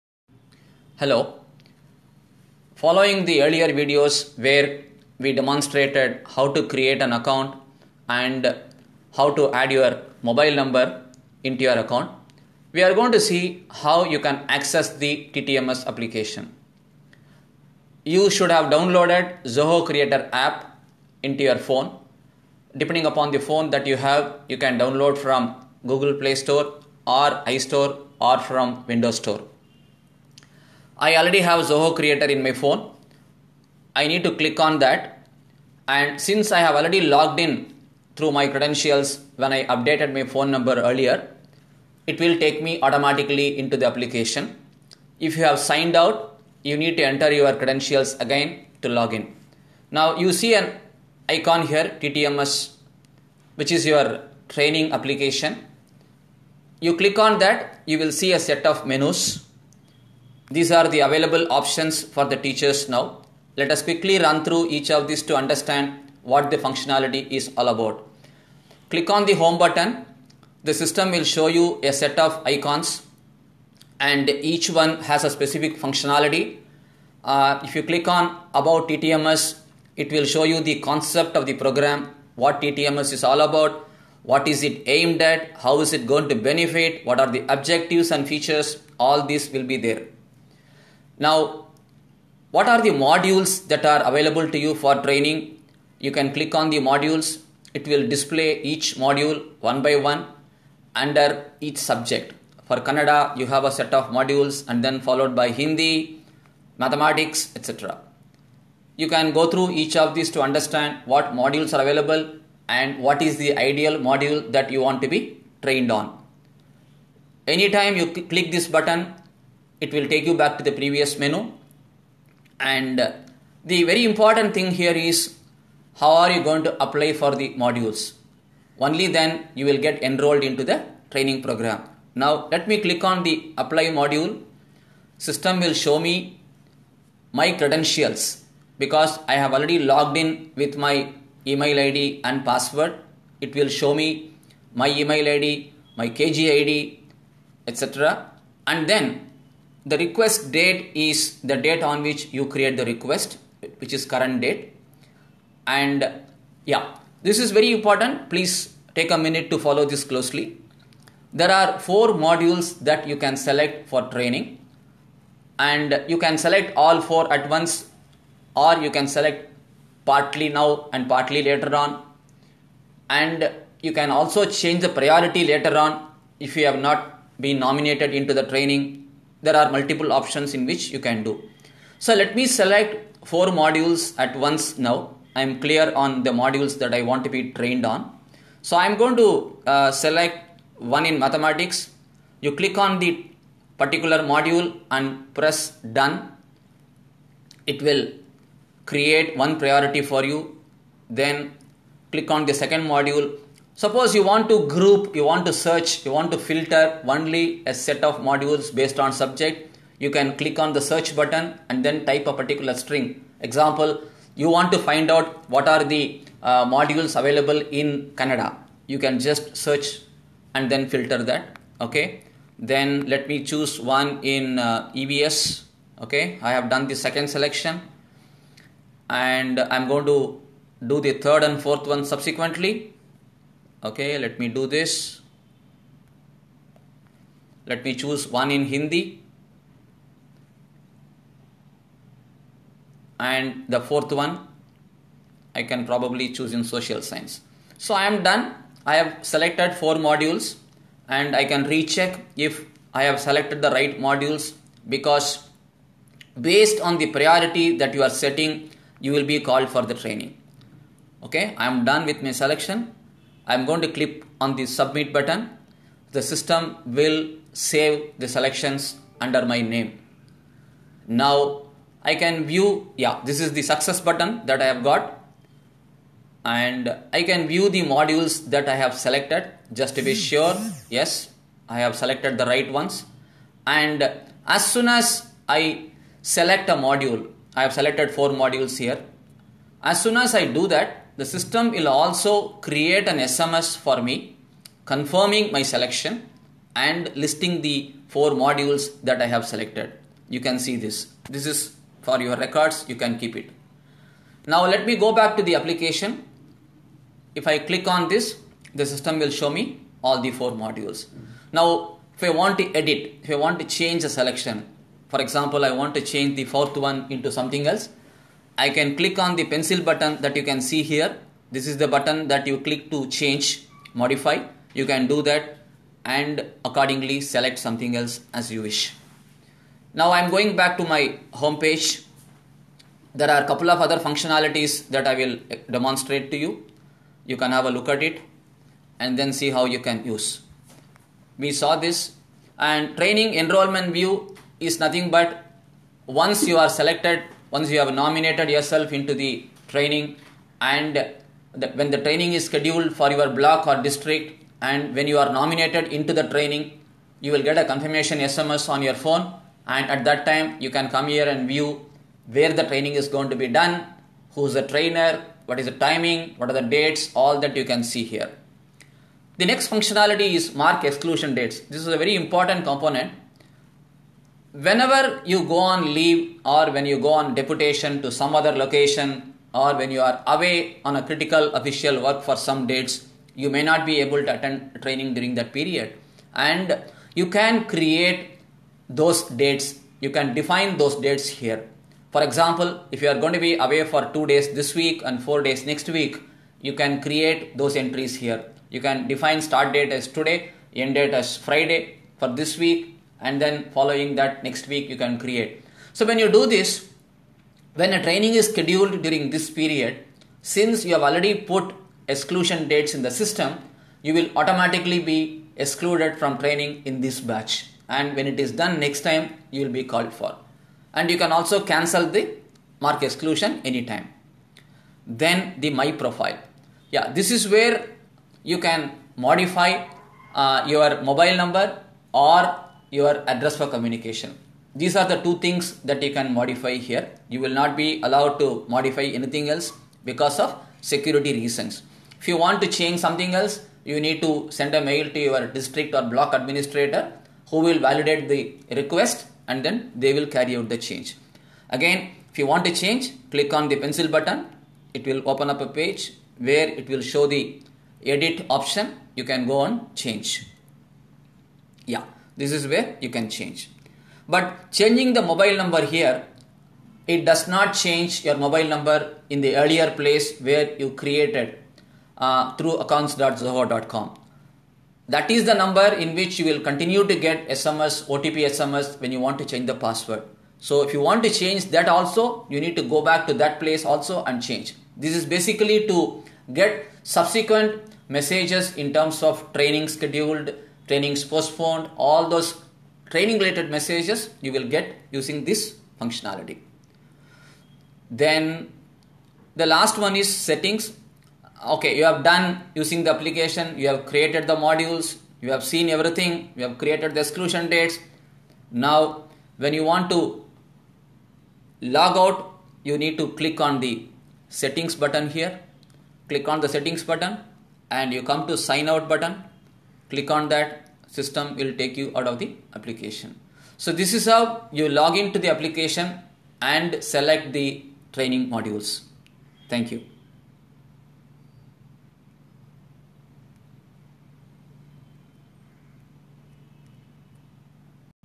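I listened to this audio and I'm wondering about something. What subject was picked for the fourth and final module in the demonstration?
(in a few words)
Social science.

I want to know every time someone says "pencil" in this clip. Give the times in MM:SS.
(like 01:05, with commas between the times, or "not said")
05:19, 07:33.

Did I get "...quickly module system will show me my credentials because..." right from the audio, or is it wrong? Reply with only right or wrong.
wrong.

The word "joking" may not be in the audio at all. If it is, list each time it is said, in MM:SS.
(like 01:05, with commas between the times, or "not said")
not said.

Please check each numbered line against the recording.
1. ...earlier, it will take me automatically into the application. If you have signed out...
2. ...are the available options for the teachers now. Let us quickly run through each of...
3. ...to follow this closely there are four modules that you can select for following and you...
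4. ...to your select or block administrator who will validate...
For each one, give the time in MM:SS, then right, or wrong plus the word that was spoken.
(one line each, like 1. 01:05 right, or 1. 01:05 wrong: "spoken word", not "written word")
1. 00:40 right
2. 01:00 right
3. 02:39 wrong: "training", not "following"
4. 07:25 wrong: "district", not "select".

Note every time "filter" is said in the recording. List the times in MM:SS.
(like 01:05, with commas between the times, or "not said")
03:26, 03:40.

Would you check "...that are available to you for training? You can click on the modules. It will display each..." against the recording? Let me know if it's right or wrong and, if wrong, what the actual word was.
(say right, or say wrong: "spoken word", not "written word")
right.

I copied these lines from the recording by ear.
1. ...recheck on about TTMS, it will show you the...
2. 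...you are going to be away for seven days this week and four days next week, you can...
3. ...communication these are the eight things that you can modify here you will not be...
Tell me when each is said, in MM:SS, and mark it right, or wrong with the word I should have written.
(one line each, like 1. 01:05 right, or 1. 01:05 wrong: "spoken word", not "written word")
1. 01:17 wrong: "click", not "recheck"
2. 06:33 wrong: "two", not "seven"
3. 07:13 wrong: "two", not "eight".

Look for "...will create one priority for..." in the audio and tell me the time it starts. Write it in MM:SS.
03:17.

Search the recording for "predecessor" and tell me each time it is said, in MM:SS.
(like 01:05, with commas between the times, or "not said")
not said.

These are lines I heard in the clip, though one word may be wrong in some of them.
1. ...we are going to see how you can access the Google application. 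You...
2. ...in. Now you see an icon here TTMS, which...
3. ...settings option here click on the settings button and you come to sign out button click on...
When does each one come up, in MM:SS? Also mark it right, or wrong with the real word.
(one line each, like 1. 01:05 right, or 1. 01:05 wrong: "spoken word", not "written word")
1. 00:12 wrong: "TTMS", not "Google"
2. 00:49 right
3. 08:34 wrong: "button", not "option".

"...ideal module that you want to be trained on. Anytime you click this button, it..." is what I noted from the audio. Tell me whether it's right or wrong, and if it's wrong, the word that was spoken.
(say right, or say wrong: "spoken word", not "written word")
right.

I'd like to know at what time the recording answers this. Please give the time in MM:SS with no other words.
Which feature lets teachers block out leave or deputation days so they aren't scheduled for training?
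06:10.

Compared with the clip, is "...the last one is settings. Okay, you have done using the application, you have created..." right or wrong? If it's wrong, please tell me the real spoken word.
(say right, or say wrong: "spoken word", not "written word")
right.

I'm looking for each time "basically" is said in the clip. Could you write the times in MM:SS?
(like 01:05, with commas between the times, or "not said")
08:05.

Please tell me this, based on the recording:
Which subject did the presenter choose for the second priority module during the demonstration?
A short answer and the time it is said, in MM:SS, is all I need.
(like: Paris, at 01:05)
EVS, at 03:44.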